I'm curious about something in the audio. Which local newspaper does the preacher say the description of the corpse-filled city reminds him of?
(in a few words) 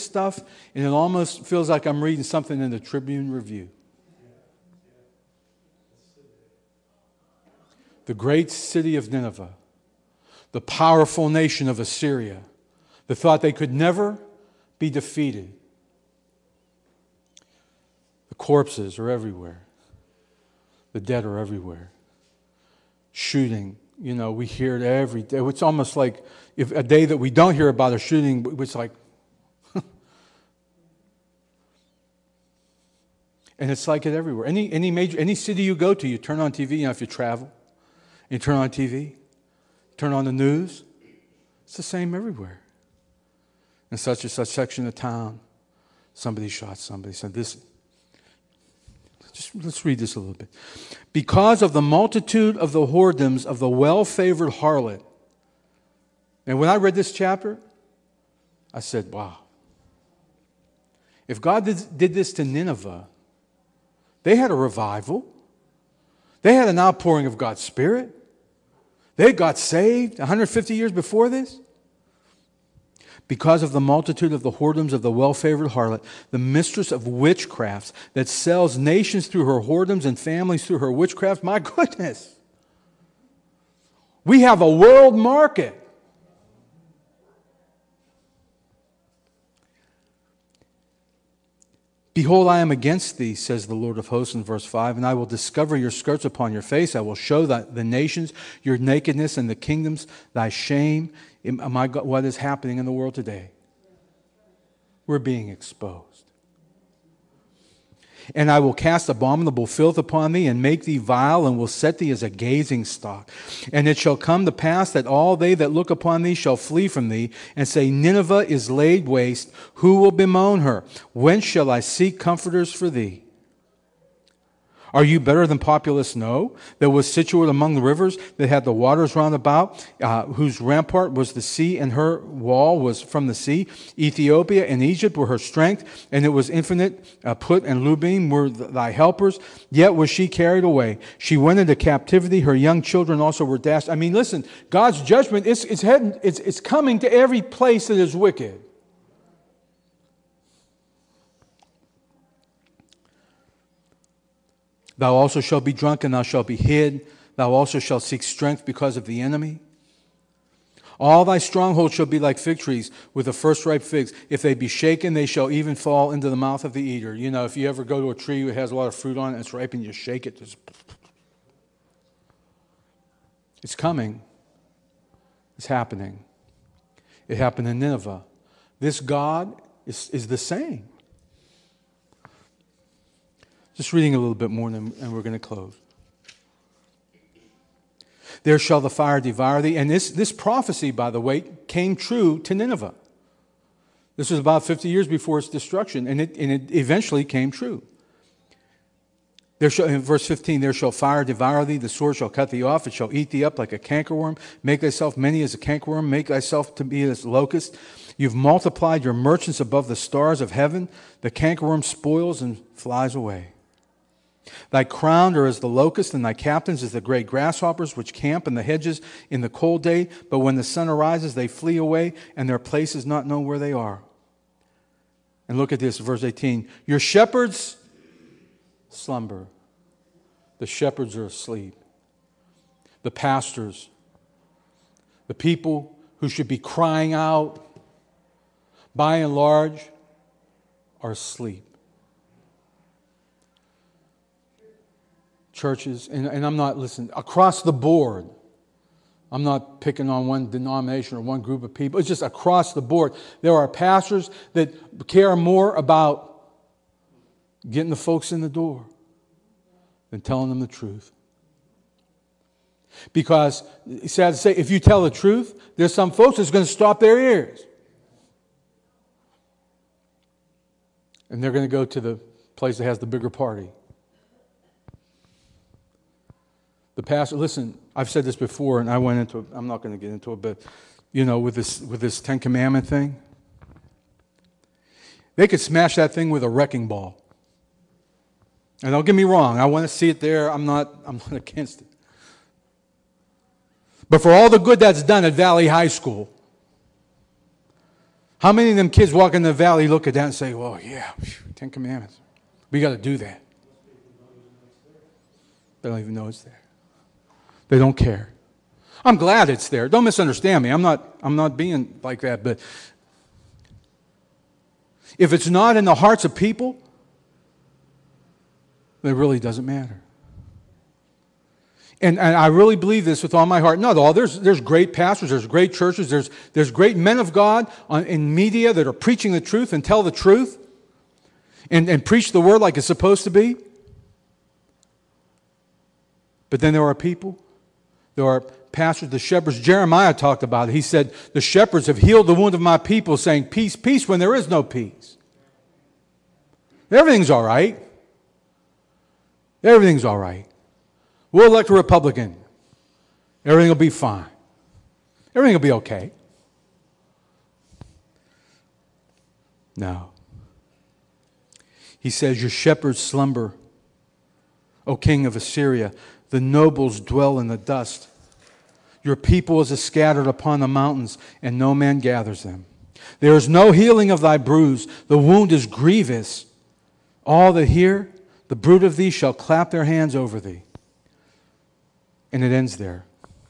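Tribune Review.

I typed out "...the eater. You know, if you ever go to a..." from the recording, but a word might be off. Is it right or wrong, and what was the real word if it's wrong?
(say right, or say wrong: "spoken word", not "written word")
right.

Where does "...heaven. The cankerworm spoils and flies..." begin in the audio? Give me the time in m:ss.
3:30.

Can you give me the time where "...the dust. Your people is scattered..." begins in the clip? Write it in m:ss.
6:07.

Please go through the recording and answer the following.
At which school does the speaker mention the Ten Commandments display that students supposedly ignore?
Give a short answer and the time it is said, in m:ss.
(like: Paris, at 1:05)
Valley High School, at 4:55.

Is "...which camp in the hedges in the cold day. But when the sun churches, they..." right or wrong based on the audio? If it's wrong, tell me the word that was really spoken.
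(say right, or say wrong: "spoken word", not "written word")
wrong: "arises", not "churches".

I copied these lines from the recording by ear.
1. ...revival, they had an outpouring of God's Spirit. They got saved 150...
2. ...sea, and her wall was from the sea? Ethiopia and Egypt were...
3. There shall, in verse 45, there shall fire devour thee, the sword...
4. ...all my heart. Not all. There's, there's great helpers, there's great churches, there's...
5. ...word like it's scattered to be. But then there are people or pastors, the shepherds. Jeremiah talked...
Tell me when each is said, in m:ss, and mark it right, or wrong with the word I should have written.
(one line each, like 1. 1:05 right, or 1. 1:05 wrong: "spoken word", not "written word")
1. 1:04 right
2. 2:11 right
3. 3:19 wrong: "15", not "45"
4. 5:23 wrong: "pastors", not "helpers"
5. 5:32 wrong: "supposed", not "scattered".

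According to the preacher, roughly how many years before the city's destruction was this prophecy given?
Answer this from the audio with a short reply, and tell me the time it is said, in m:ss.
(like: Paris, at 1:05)
50, at 3:14.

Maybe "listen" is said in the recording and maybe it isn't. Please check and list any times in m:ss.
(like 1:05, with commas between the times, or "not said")
2:24, 4:06, 4:37.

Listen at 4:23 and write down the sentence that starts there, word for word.
Because, sad to say, if you tell the truth, there's some folks that's going to stop their ears.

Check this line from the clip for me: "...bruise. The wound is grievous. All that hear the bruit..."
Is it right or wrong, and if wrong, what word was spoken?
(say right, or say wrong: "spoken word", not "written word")
right.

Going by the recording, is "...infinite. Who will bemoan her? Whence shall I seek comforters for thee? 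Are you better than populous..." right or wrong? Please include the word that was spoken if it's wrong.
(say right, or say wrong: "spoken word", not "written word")
wrong: "waste", not "infinite".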